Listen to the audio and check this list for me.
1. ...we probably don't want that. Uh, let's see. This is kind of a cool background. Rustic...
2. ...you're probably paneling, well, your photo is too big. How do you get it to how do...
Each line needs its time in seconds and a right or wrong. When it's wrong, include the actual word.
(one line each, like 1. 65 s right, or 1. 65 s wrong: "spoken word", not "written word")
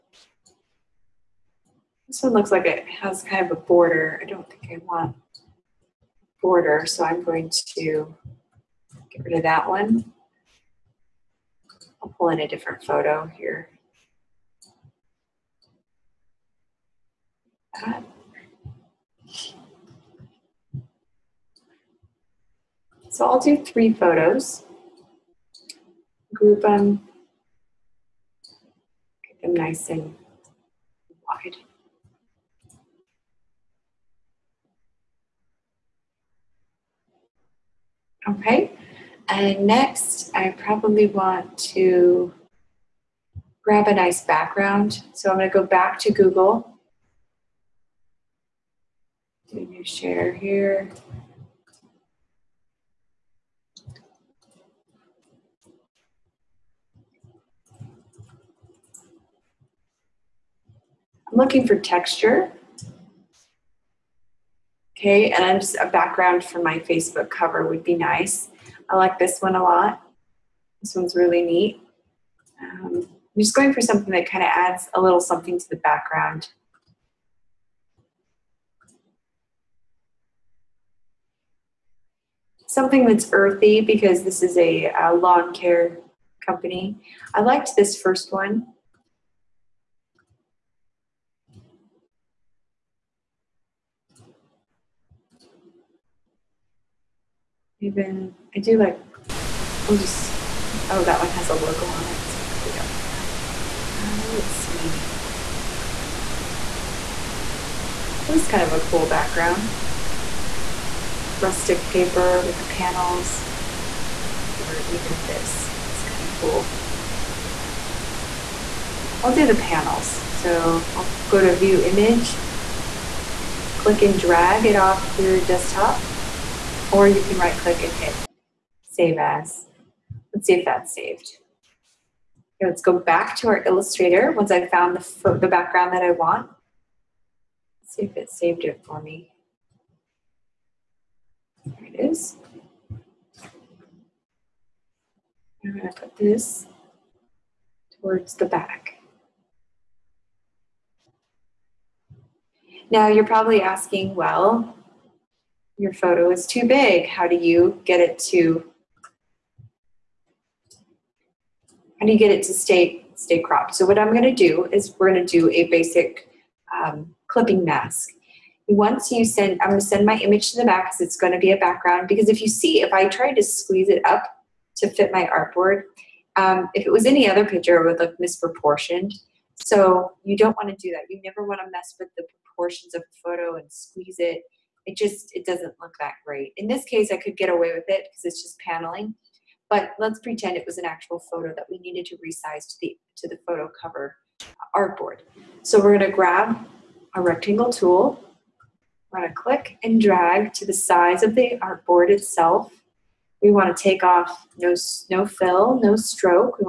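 1. 102 s right
2. 153 s wrong: "asking", not "paneling".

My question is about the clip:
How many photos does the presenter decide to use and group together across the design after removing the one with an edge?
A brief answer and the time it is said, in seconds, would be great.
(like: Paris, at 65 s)
3, at 23 s.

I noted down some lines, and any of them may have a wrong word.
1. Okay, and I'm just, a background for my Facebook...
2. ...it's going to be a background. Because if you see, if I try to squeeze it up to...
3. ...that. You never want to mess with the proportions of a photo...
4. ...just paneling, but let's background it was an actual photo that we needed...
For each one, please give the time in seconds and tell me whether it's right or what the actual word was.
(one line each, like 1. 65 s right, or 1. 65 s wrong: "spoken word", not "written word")
1. 64 s right
2. 171 s right
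3. 180 s right
4. 188 s wrong: "pretend", not "background".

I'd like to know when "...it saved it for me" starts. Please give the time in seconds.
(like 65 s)
138 s.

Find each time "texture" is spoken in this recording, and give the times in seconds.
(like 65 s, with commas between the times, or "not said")
61 s.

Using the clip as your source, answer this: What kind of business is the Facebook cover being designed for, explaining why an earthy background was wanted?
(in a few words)
lawn care company.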